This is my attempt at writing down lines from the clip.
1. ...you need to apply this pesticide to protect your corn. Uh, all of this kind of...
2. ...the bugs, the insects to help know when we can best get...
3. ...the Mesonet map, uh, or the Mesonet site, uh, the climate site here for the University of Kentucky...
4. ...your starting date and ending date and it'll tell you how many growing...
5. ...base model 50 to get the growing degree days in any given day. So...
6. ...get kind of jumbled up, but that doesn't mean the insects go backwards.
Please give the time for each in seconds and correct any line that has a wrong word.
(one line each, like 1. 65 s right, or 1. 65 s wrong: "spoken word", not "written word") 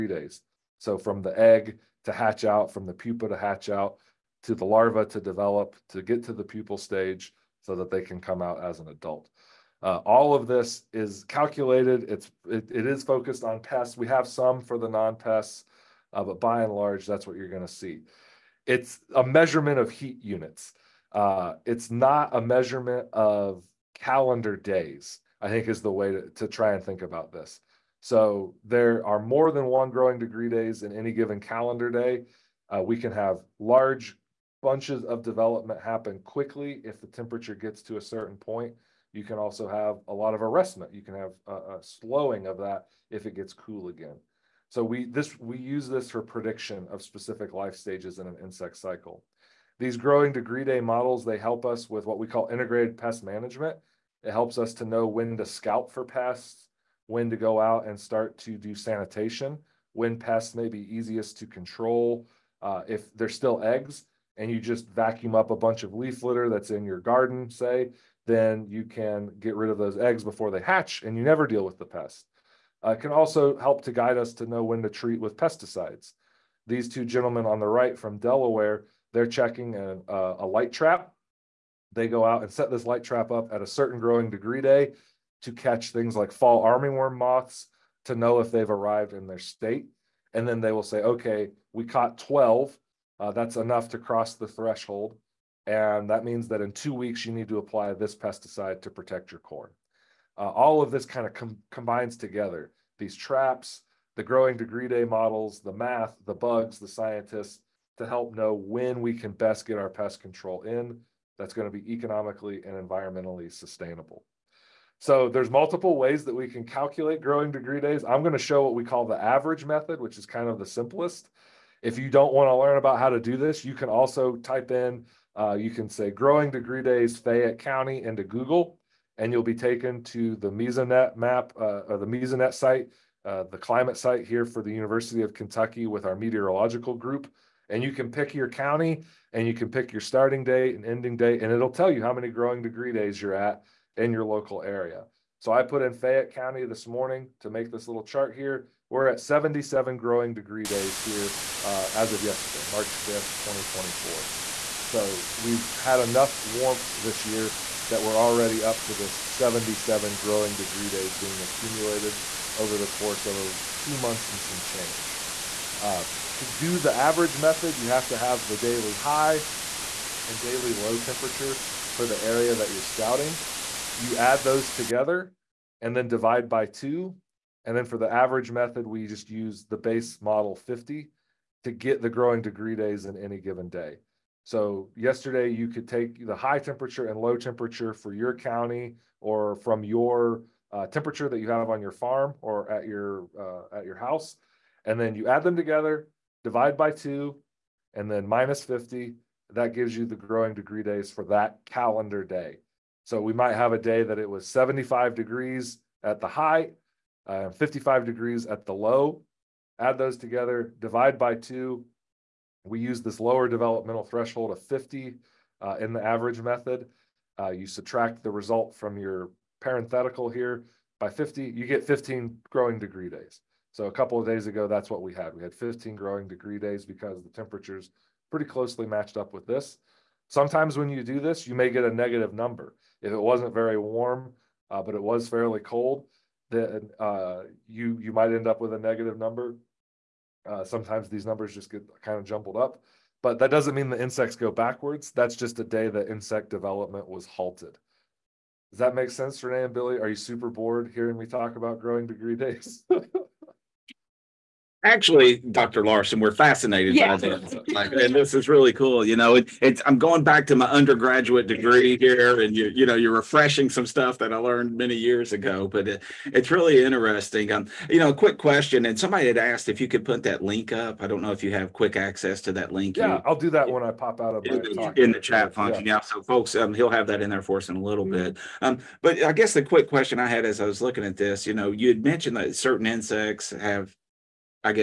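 1. 97 s right
2. 106 s wrong: "scientists", not "insects"
3. 130 s right
4. 139 s right
5. 179 s right
6. 241 s right.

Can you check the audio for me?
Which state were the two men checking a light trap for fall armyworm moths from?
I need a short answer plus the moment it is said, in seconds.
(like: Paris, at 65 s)
Delaware, at 78 s.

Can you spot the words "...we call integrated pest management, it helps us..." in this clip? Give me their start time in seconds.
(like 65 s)
52 s.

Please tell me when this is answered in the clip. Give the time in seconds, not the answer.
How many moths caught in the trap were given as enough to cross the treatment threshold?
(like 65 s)
92 s.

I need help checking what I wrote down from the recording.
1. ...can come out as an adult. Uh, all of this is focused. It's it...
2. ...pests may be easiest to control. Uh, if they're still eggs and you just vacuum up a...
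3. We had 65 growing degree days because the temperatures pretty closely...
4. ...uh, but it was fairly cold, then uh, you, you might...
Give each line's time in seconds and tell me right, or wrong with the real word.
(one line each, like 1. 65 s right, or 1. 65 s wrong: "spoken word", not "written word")
1. 8 s wrong: "calculated", not "focused"
2. 60 s right
3. 225 s wrong: "15", not "65"
4. 234 s right.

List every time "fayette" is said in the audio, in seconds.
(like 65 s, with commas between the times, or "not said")
127 s, 145 s.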